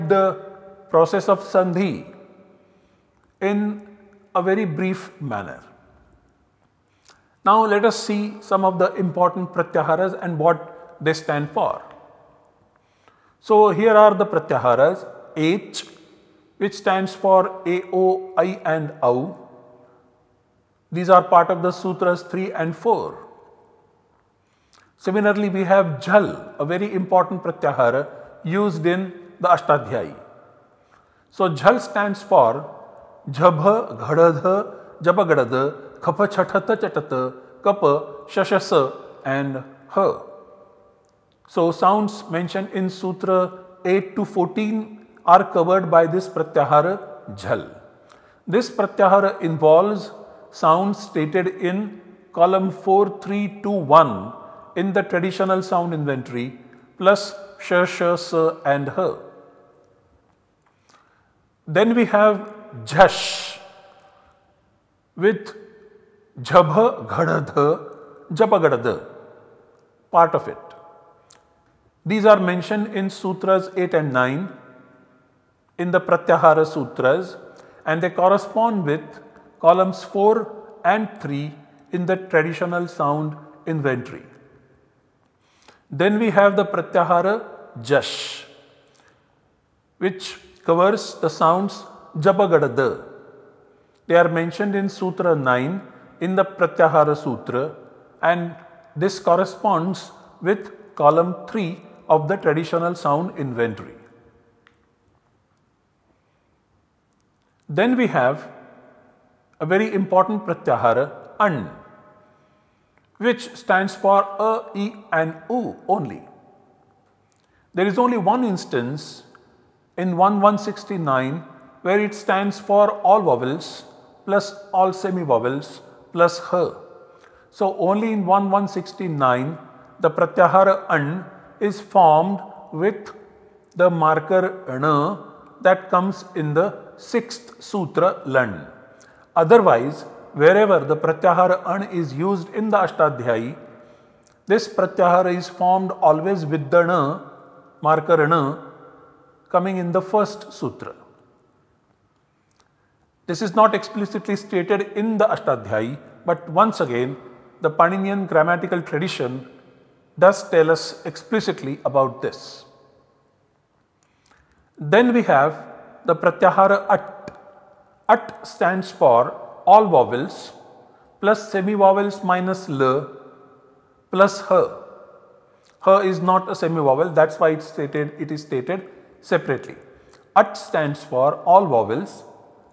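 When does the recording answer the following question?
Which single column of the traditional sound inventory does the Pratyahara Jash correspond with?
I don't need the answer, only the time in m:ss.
1:40.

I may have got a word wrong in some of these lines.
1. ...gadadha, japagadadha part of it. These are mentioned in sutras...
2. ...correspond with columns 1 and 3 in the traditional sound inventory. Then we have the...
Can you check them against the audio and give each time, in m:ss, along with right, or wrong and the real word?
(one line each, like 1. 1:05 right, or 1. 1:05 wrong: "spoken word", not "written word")
1. 1:07 right
2. 1:18 wrong: "4", not "1".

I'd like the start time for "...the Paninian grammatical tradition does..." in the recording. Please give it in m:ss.
2:37.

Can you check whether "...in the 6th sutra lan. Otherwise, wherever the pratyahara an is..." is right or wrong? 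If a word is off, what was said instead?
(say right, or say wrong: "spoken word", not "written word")
right.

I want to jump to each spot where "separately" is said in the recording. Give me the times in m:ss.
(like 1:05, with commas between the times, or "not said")
2:59.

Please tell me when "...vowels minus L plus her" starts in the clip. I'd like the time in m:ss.
2:51.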